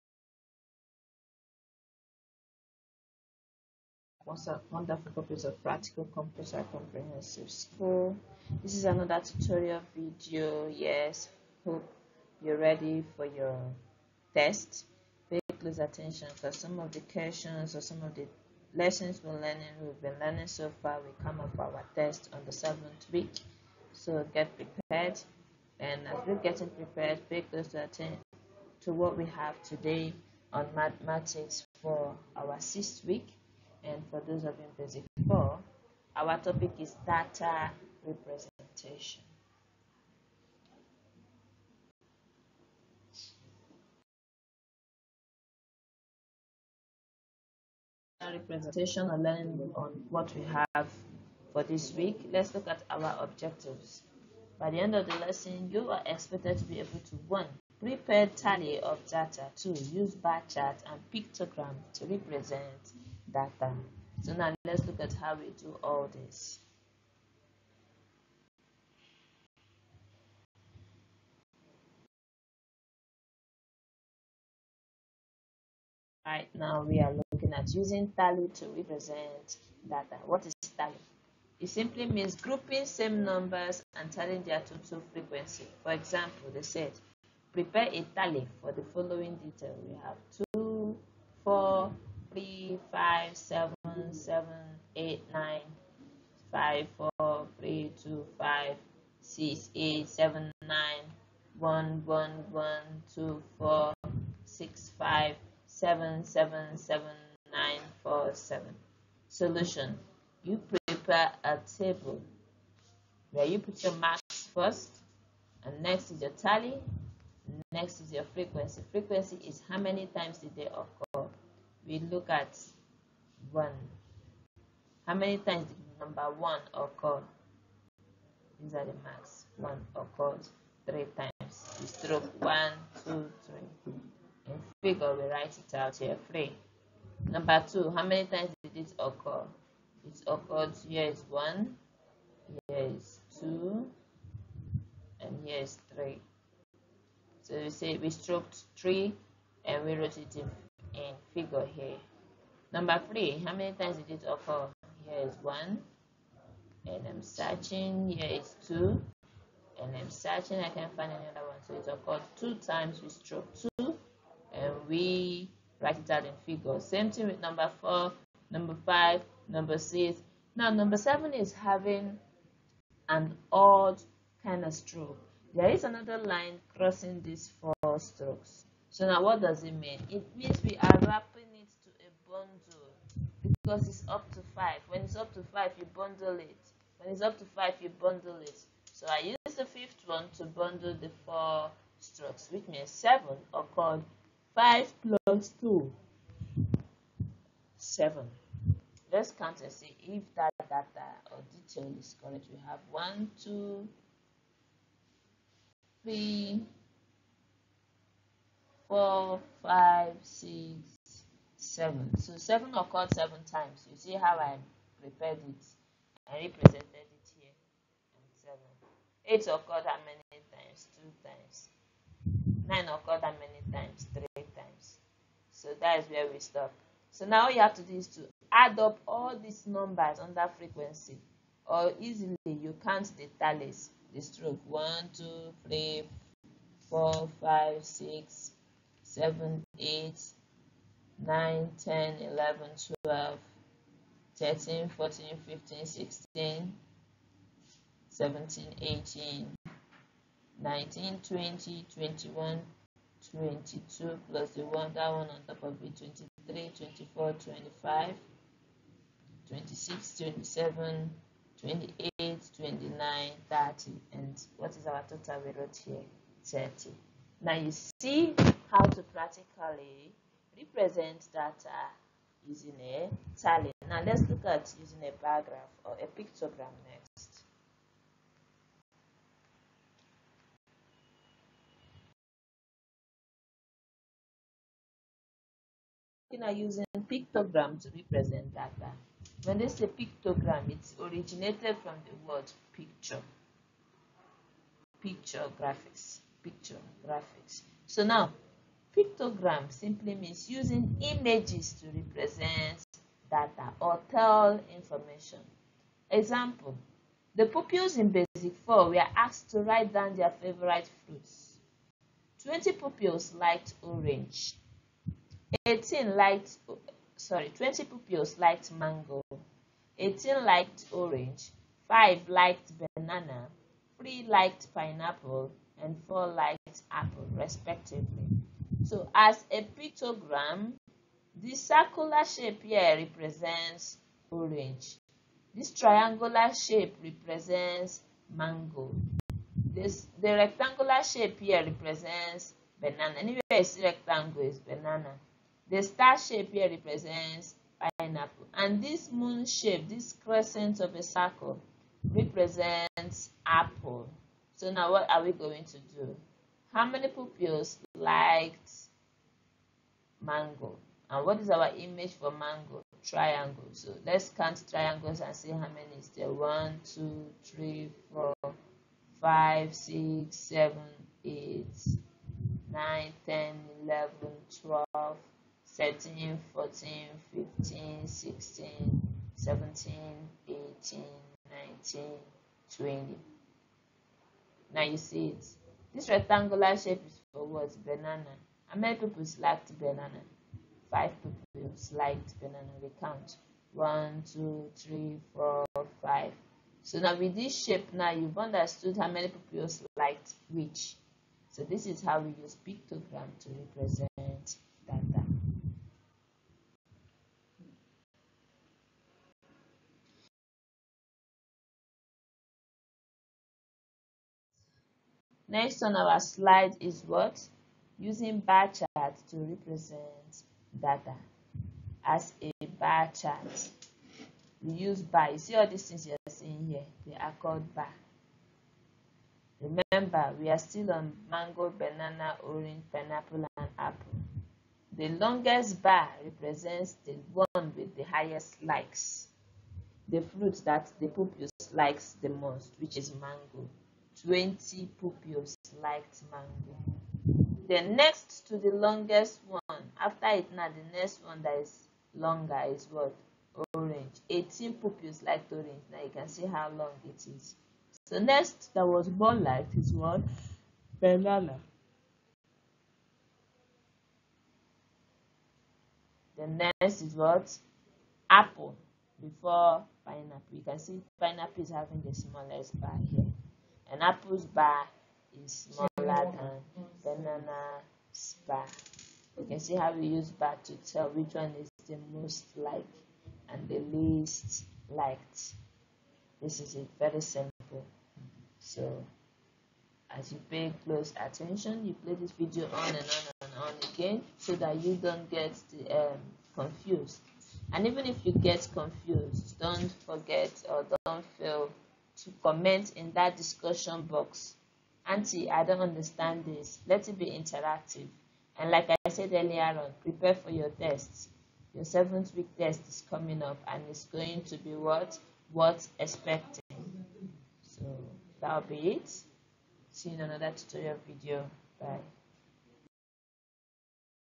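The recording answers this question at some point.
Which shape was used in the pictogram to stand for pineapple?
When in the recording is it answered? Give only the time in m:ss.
5:45.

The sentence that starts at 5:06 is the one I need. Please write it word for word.
Example, the pupils in Basic 4 were asked to write down their favorite fruits.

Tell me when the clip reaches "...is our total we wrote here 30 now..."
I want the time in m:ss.
4:24.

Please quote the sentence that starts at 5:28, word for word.
So as a pictogram, this circular shape here represents orange.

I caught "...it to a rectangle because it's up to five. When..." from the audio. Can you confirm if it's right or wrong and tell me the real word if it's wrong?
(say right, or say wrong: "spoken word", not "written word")
wrong: "bundle", not "rectangle".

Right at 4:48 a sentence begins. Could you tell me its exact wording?
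Uh, when they say pictogram, it's originated from the word picture.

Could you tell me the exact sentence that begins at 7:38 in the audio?
So next that was more liked is what?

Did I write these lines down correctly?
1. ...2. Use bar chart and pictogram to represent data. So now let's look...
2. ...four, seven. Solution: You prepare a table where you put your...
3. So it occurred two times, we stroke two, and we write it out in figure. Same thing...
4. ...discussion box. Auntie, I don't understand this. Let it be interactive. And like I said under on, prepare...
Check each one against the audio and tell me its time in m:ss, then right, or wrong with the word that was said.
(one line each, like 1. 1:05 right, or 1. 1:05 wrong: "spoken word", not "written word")
1. 0:59 right
2. 1:48 right
3. 2:41 right
4. 8:23 wrong: "earlier", not "under".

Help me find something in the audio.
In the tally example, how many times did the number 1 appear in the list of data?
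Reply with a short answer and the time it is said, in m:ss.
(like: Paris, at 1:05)
3, at 2:09.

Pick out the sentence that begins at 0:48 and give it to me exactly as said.
representation and learning on what we have for this week, let's look at our objectives.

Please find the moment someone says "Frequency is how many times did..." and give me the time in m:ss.
1:58.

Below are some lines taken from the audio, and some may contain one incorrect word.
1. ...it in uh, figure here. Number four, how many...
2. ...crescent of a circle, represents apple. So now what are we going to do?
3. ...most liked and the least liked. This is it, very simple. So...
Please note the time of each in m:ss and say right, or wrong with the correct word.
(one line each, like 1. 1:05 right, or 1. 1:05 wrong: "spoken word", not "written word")
1. 2:30 wrong: "three", not "four"
2. 5:50 right
3. 8:02 right.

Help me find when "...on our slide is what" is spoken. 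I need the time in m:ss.
6:55.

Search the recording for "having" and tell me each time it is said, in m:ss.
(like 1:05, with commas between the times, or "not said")
2:51, 7:51.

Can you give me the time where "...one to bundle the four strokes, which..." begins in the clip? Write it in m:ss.
3:10.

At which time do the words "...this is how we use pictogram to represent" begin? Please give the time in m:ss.
6:41.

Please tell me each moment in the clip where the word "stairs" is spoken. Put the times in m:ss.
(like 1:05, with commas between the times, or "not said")
not said.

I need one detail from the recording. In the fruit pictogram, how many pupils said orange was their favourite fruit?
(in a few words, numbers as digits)
18.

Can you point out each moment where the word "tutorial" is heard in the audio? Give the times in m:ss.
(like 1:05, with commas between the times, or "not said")
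0:09, 8:40.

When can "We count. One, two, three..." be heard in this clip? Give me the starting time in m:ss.
6:32.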